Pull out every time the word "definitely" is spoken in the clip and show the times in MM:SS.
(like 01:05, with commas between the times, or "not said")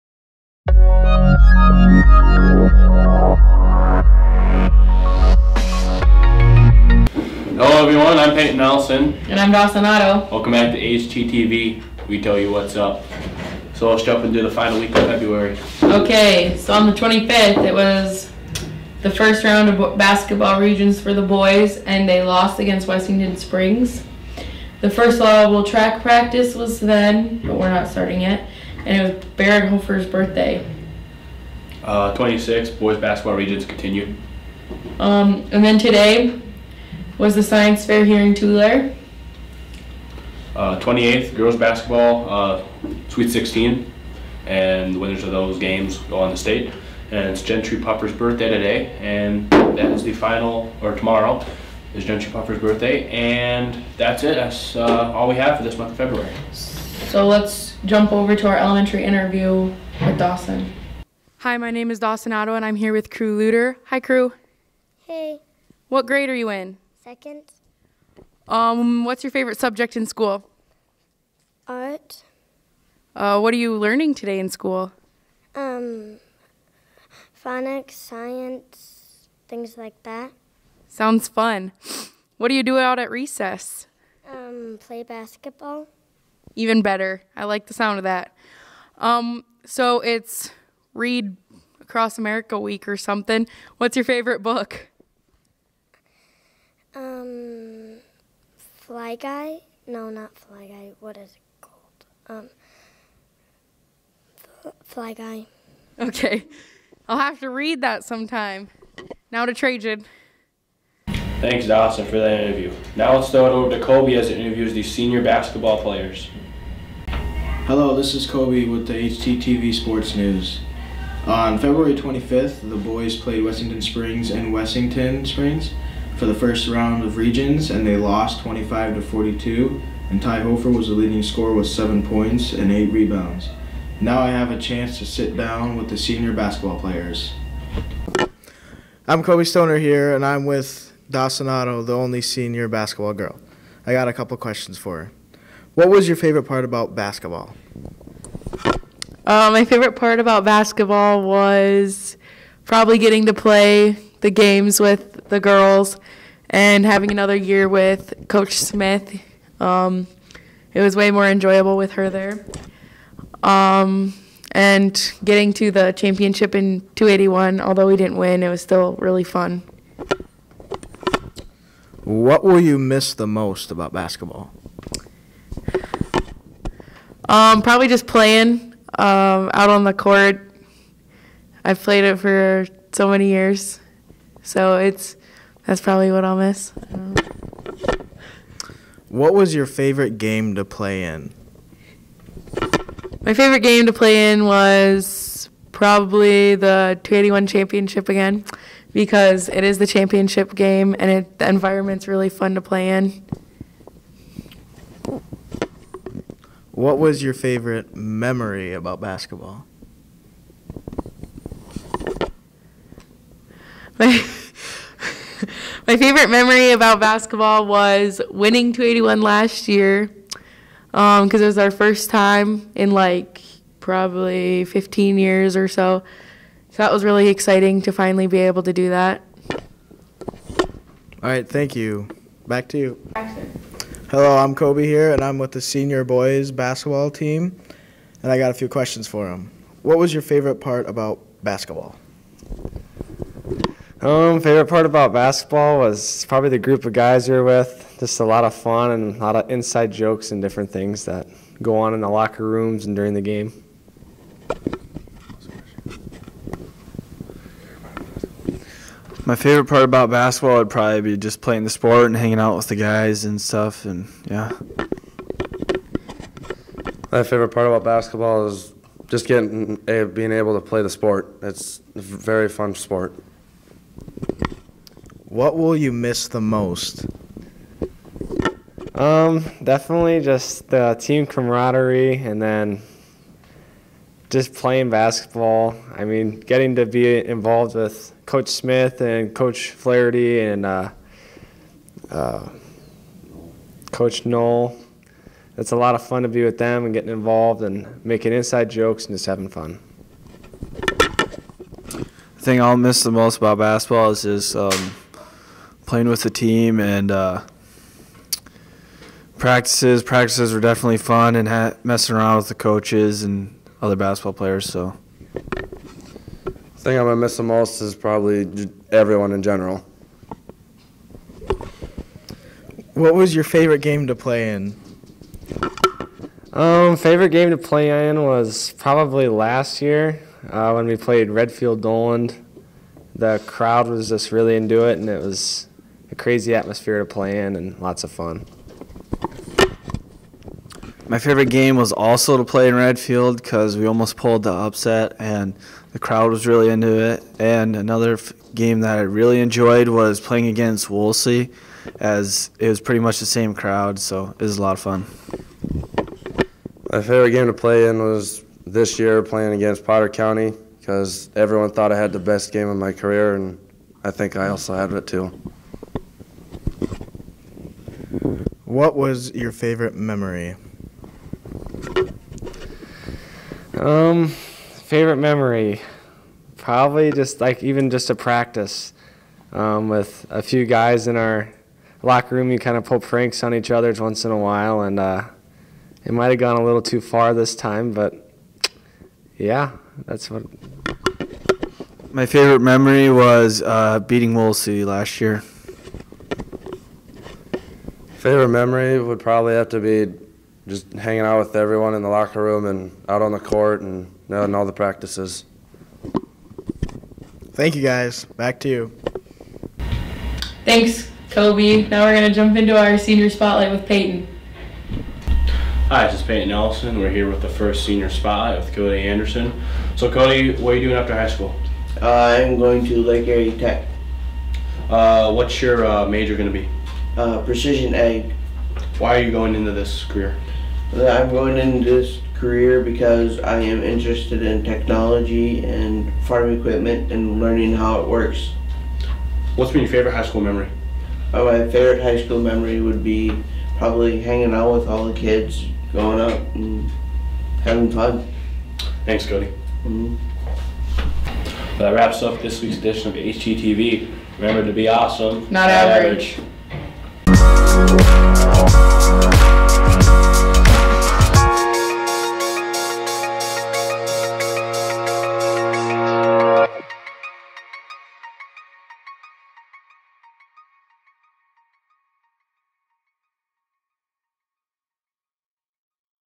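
04:39, 05:10.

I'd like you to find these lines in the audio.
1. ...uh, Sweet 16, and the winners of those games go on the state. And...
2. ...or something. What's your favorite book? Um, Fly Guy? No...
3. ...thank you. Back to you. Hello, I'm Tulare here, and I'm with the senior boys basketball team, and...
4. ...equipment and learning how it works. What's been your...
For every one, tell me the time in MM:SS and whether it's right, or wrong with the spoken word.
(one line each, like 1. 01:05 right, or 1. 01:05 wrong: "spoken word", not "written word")
1. 00:42 right
2. 01:32 right
3. 03:51 wrong: "Kobe", not "Tulare"
4. 07:16 right.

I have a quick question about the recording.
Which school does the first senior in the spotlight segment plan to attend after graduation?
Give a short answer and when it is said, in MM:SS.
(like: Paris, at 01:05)
Lake Area Tech, at 07:02.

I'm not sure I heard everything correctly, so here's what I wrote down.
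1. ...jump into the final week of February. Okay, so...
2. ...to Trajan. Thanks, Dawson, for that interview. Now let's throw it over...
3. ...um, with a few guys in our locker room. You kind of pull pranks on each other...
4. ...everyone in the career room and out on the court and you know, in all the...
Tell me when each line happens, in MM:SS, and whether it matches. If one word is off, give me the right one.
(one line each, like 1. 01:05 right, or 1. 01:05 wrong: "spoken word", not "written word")
1. 00:14 right
2. 01:49 right
3. 06:19 right
4. 06:41 wrong: "locker", not "career".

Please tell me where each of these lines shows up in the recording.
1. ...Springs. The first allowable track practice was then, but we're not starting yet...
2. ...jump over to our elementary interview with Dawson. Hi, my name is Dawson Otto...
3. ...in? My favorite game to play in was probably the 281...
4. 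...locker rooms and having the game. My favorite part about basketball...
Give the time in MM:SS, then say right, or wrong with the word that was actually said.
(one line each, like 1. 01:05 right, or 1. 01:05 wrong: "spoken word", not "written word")
1. 00:23 right
2. 00:57 right
3. 03:11 right
4. 04:12 wrong: "during", not "having".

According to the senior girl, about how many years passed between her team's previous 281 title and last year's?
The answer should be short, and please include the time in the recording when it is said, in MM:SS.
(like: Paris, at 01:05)
15, at 03:44.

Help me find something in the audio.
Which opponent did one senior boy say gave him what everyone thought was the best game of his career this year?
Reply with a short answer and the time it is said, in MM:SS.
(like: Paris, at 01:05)
Potter County, at 05:59.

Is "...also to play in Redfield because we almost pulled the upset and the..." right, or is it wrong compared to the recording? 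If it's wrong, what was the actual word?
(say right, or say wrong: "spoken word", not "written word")
right.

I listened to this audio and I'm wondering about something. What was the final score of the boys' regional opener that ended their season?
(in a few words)
25 to 42.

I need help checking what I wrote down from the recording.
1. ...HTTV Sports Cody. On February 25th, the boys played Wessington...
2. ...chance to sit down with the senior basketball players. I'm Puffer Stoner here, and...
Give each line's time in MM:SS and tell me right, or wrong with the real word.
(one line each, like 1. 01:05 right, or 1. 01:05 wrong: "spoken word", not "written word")
1. 01:58 wrong: "News", not "Cody"
2. 02:14 wrong: "Kobe", not "Puffer".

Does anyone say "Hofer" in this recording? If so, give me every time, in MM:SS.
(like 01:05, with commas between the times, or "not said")
00:29, 02:10.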